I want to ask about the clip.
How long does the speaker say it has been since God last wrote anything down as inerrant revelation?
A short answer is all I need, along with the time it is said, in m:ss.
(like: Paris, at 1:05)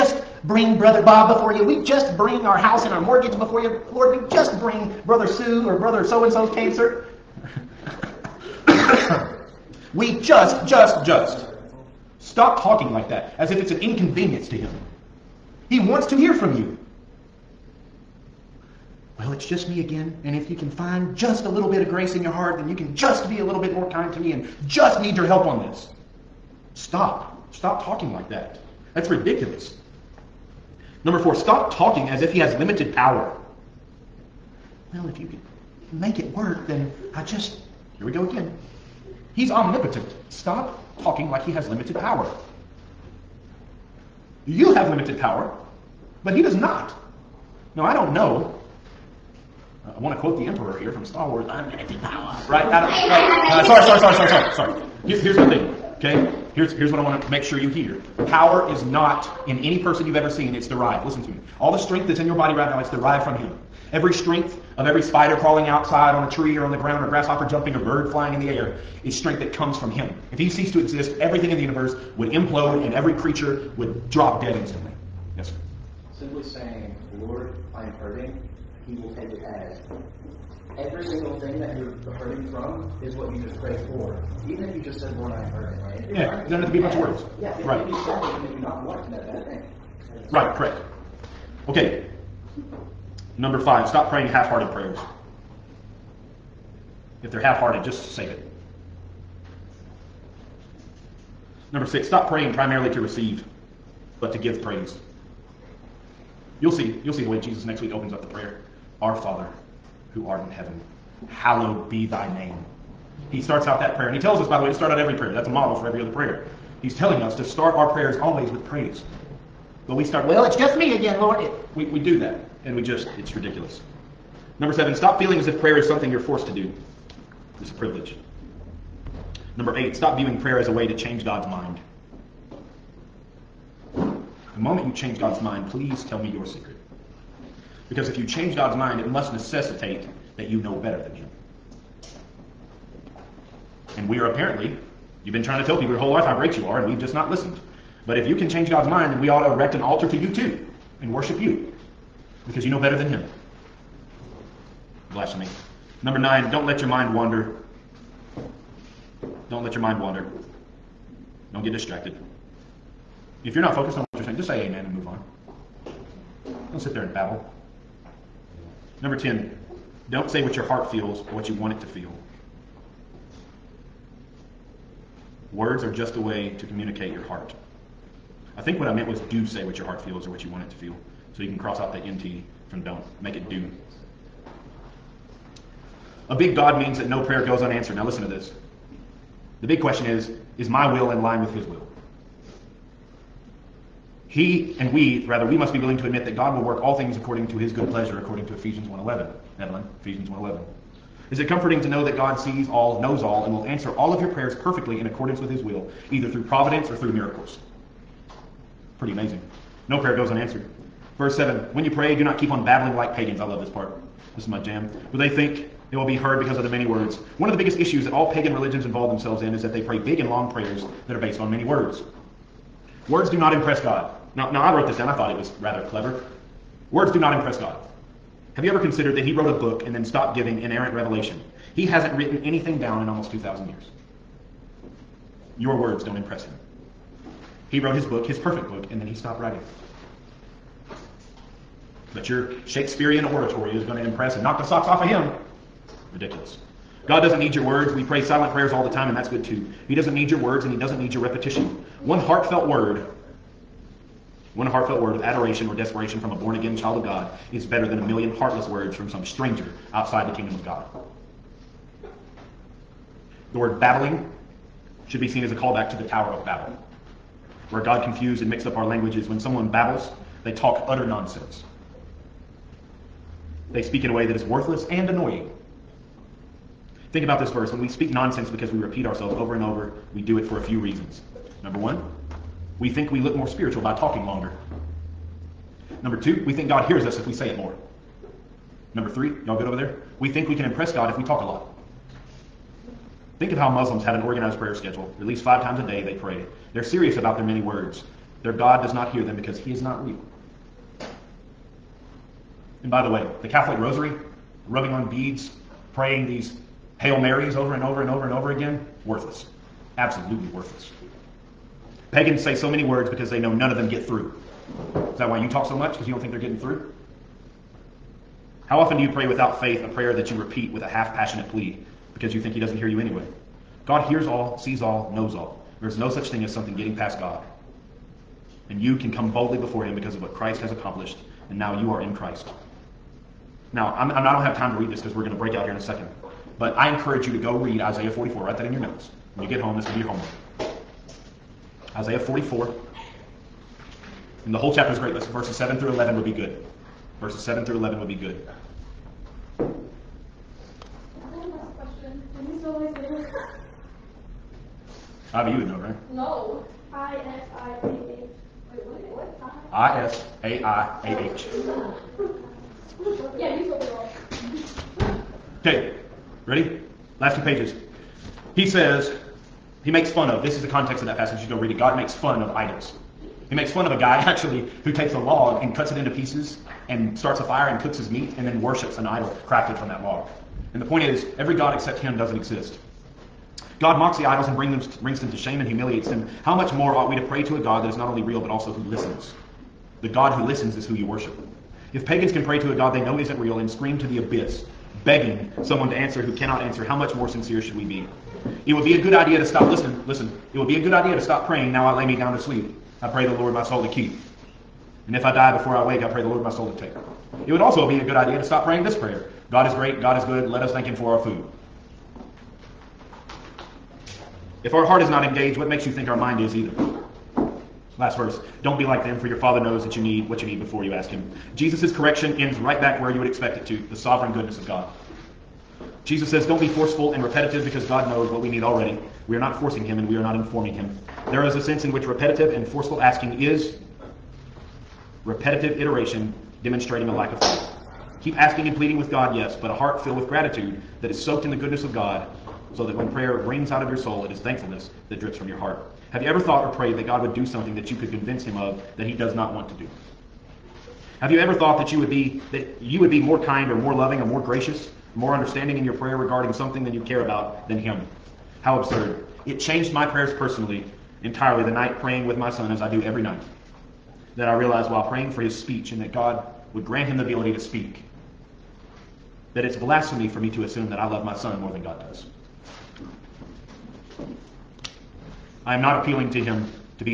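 almost 2,000 years, at 3:53.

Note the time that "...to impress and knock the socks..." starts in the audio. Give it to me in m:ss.
4:03.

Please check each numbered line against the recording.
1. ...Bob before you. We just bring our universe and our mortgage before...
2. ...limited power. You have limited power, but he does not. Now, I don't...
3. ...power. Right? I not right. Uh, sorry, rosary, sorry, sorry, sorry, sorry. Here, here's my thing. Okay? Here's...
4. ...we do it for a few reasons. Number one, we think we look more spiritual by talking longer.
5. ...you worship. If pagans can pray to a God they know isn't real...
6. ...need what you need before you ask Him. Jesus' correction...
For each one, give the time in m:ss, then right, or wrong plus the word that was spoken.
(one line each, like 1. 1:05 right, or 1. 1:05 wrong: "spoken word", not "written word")
1. 0:01 wrong: "house", not "universe"
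2. 0:41 right
3. 0:52 wrong: "sorry", not "rosary"
4. 4:40 right
5. 6:30 right
6. 6:59 right.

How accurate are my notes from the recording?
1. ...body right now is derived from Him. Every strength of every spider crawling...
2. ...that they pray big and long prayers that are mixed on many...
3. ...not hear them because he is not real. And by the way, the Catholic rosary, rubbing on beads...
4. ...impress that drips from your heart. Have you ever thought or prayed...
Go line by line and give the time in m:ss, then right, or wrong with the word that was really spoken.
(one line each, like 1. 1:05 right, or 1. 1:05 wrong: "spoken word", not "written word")
1. 1:02 right
2. 3:39 wrong: "based", not "mixed"
3. 4:58 right
4. 7:24 wrong: "thankfulness", not "impress".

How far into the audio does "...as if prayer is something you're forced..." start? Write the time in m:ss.
2:05.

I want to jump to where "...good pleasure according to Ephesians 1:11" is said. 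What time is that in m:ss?
3:17.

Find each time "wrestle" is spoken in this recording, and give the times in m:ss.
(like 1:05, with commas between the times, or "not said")
not said.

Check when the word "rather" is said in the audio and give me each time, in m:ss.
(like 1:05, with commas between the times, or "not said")
3:15, 3:45.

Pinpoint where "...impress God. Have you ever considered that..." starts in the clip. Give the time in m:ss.
3:47.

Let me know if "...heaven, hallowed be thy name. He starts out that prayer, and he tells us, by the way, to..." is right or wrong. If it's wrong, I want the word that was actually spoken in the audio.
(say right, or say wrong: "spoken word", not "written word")
right.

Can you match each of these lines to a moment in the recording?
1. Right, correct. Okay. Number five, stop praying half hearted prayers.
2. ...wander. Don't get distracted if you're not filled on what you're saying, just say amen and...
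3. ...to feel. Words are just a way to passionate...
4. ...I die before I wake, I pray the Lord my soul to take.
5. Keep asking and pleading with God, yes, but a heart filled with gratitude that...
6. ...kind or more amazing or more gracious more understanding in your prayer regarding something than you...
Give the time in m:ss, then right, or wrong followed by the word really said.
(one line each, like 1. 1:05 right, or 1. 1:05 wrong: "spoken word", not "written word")
1. 1:30 right
2. 2:40 wrong: "focused", not "filled"
3. 2:51 wrong: "communicate", not "passionate"
4. 6:45 right
5. 7:18 right
6. 7:33 wrong: "loving", not "amazing".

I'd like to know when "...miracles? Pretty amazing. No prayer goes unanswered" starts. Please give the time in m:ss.
3:27.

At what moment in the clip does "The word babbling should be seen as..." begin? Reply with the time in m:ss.
4:23.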